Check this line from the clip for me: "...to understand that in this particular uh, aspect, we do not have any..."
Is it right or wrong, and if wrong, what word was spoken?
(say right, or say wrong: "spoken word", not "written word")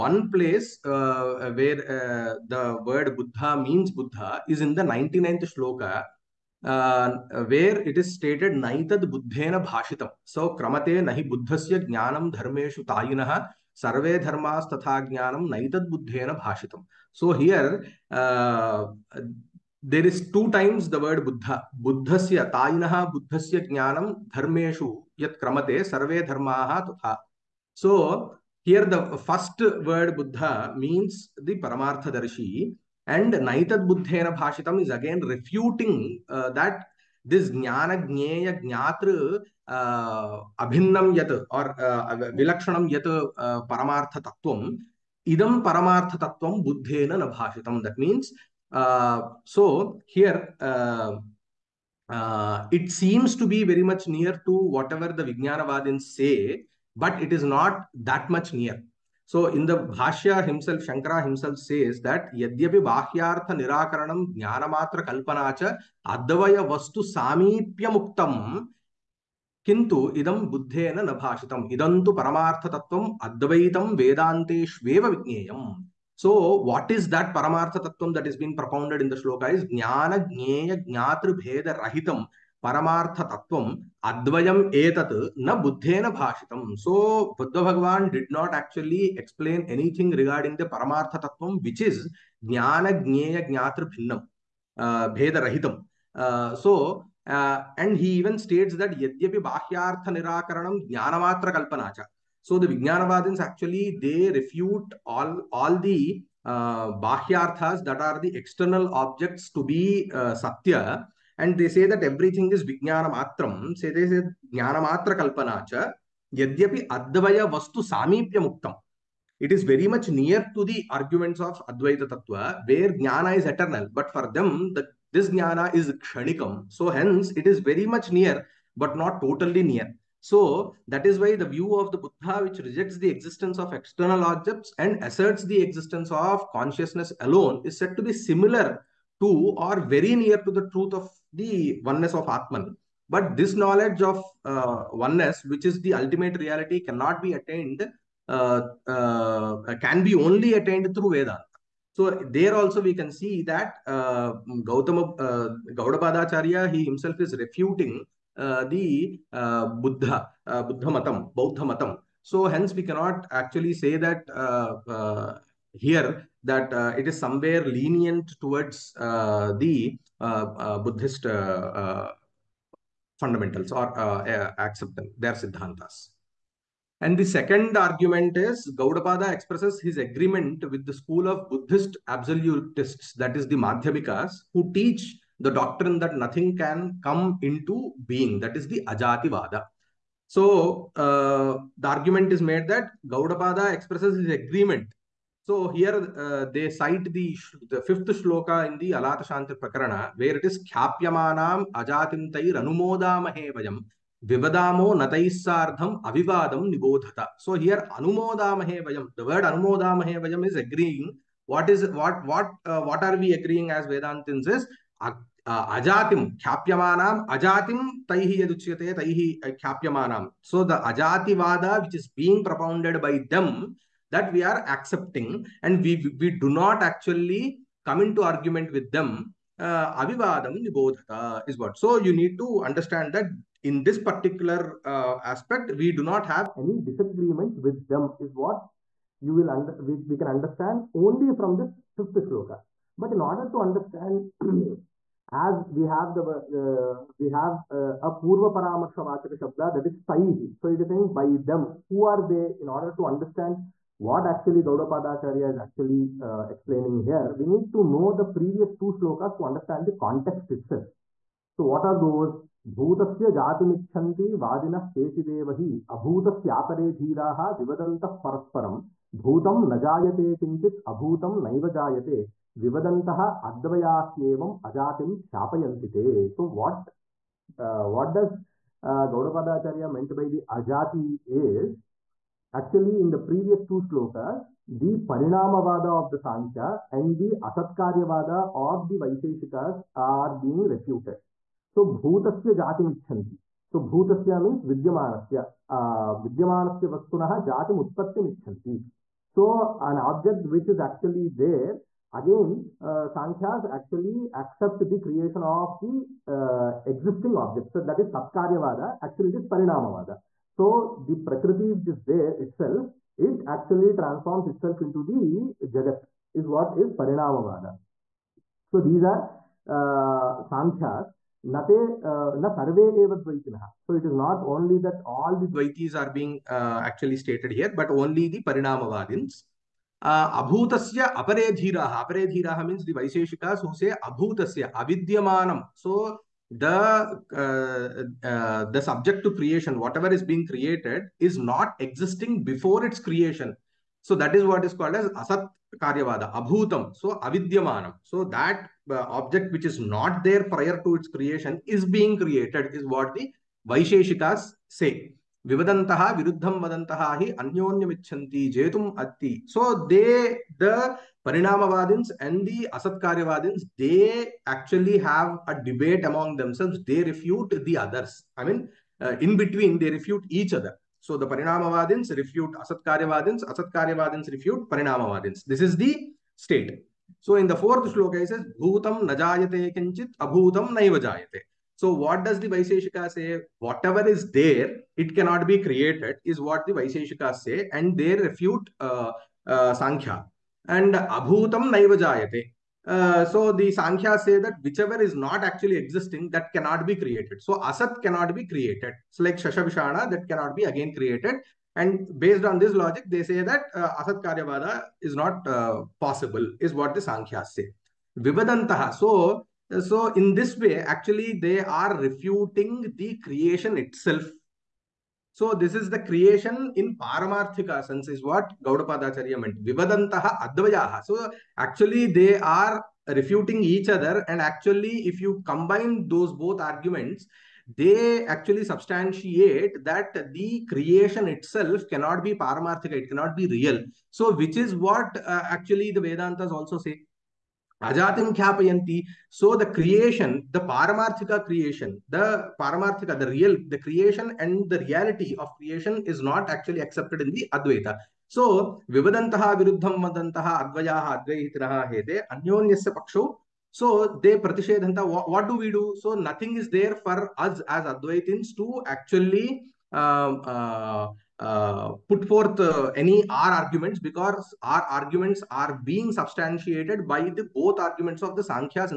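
right.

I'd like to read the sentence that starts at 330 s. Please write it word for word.
Uh, abhutasya అపరేధీరాహ అపరేధీరాహ means the వైశేషికాస్ who say abhutasya avidyamanam.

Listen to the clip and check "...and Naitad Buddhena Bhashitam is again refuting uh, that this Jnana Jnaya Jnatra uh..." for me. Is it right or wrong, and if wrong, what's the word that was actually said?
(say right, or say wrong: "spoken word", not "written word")
right.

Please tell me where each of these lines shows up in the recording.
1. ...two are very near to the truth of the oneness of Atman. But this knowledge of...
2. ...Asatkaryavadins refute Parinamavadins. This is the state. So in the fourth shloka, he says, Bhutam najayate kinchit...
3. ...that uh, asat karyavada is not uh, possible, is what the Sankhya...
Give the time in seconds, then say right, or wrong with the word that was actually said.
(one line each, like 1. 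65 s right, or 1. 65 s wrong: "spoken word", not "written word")
1. 139 s right
2. 373 s right
3. 403 s right.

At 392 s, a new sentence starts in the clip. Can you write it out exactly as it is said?
Uh, so the Sankhya say that whichever is not actually existing, that cannot be created.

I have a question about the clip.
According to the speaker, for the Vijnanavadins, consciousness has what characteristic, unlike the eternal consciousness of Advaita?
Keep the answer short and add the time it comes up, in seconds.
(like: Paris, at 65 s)
Kshanikam, at 125 s.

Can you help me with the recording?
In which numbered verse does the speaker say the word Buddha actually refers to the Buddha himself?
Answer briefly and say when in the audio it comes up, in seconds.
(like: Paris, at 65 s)
99th, at 4 s.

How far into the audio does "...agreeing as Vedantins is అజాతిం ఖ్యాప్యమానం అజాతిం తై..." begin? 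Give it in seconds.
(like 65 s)
213 s.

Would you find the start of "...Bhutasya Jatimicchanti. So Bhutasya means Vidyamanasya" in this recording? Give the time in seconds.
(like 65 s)
291 s.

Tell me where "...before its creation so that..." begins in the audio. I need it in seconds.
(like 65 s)
342 s.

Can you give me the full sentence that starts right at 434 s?
So which is what uh, actually the Vedantas also say.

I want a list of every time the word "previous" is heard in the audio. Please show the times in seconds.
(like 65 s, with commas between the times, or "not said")
258 s, 283 s.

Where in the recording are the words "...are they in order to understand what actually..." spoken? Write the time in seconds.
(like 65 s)
252 s.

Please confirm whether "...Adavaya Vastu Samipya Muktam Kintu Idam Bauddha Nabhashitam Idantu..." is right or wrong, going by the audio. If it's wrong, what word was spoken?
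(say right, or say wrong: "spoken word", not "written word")
wrong: "Buddhena", not "Bauddha".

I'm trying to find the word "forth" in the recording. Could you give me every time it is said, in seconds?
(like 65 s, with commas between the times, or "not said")
462 s.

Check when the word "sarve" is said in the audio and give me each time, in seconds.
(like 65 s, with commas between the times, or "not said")
13 s, 25 s, 322 s.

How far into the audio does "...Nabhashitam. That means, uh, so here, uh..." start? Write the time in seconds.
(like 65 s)
47 s.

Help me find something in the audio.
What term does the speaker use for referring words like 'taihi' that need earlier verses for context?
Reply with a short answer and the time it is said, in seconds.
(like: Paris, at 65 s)
Purva paramarsha vachaka shabda, at 248 s.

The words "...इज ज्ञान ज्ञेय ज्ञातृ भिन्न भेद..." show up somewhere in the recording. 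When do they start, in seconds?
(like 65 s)
91 s.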